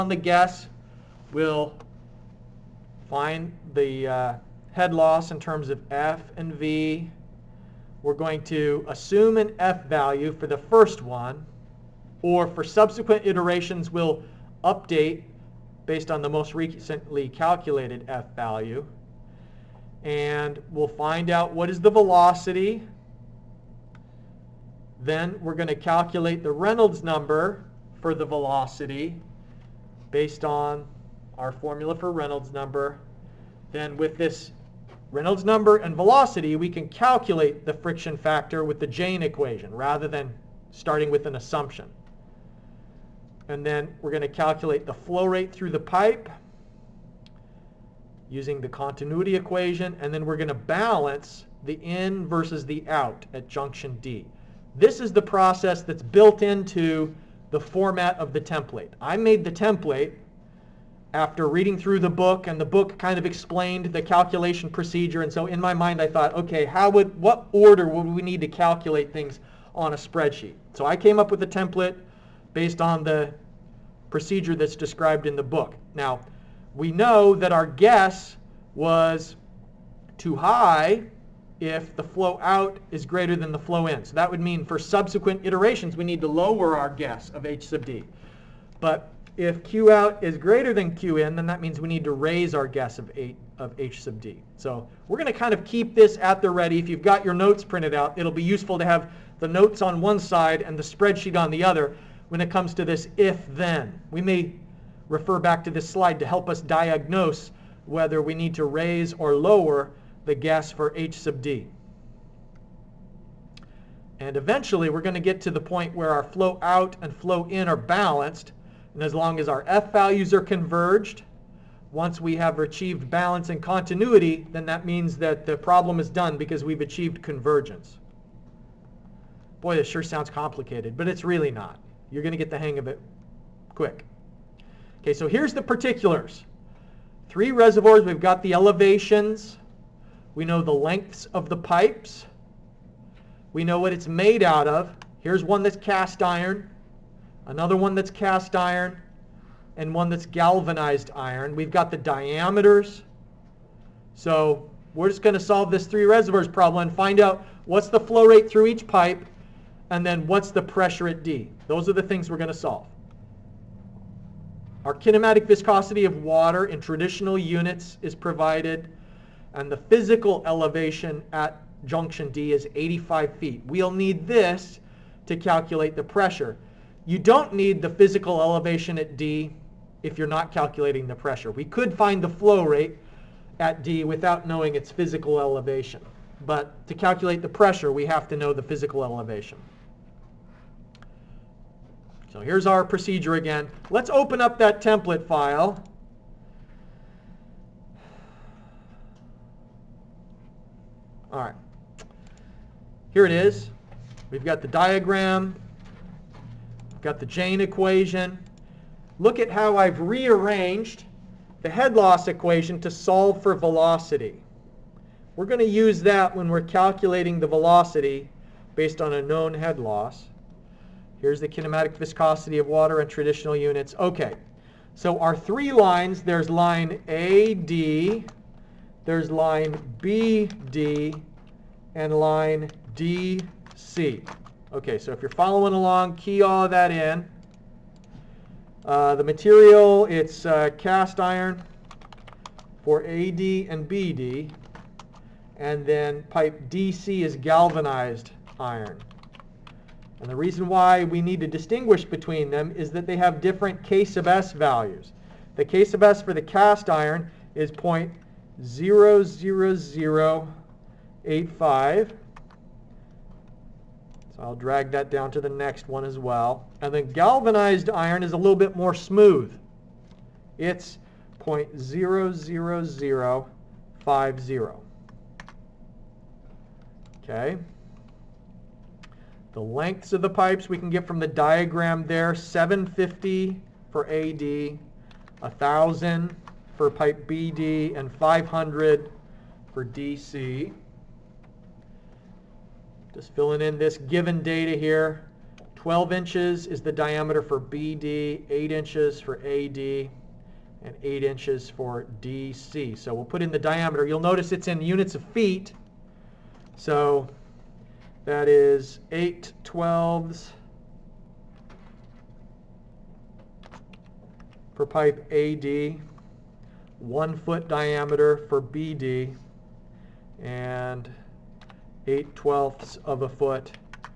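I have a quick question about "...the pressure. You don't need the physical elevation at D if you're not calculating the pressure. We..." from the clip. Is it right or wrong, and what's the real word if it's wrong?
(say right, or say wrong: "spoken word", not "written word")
right.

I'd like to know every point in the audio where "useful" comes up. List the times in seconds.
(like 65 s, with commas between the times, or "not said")
98 s.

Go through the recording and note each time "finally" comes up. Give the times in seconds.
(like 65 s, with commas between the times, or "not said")
not said.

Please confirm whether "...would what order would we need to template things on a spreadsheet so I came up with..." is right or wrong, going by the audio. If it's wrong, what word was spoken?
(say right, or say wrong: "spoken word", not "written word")
wrong: "calculate", not "template".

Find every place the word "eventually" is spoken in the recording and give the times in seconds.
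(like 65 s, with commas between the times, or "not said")
114 s.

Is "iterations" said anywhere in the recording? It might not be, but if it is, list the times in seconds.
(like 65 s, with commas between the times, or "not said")
13 s, 85 s.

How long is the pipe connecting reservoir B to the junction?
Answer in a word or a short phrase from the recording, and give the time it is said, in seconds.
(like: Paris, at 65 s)
1,000, at 285 s.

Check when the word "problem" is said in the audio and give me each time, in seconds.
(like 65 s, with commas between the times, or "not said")
125 s, 156 s.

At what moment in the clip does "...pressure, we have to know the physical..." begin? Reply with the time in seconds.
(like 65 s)
187 s.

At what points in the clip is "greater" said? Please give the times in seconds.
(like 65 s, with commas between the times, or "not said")
83 s, 90 s.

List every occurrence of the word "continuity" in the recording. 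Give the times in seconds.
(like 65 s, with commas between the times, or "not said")
48 s, 123 s.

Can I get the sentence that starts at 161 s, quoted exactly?
Those are the things we're going to solve.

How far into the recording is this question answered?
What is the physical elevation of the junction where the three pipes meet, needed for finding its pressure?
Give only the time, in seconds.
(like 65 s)
172 s.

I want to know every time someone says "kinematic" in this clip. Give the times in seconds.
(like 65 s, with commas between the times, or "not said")
164 s, 221 s.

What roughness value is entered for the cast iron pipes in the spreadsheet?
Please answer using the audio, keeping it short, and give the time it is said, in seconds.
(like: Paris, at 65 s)
0.00085, at 257 s.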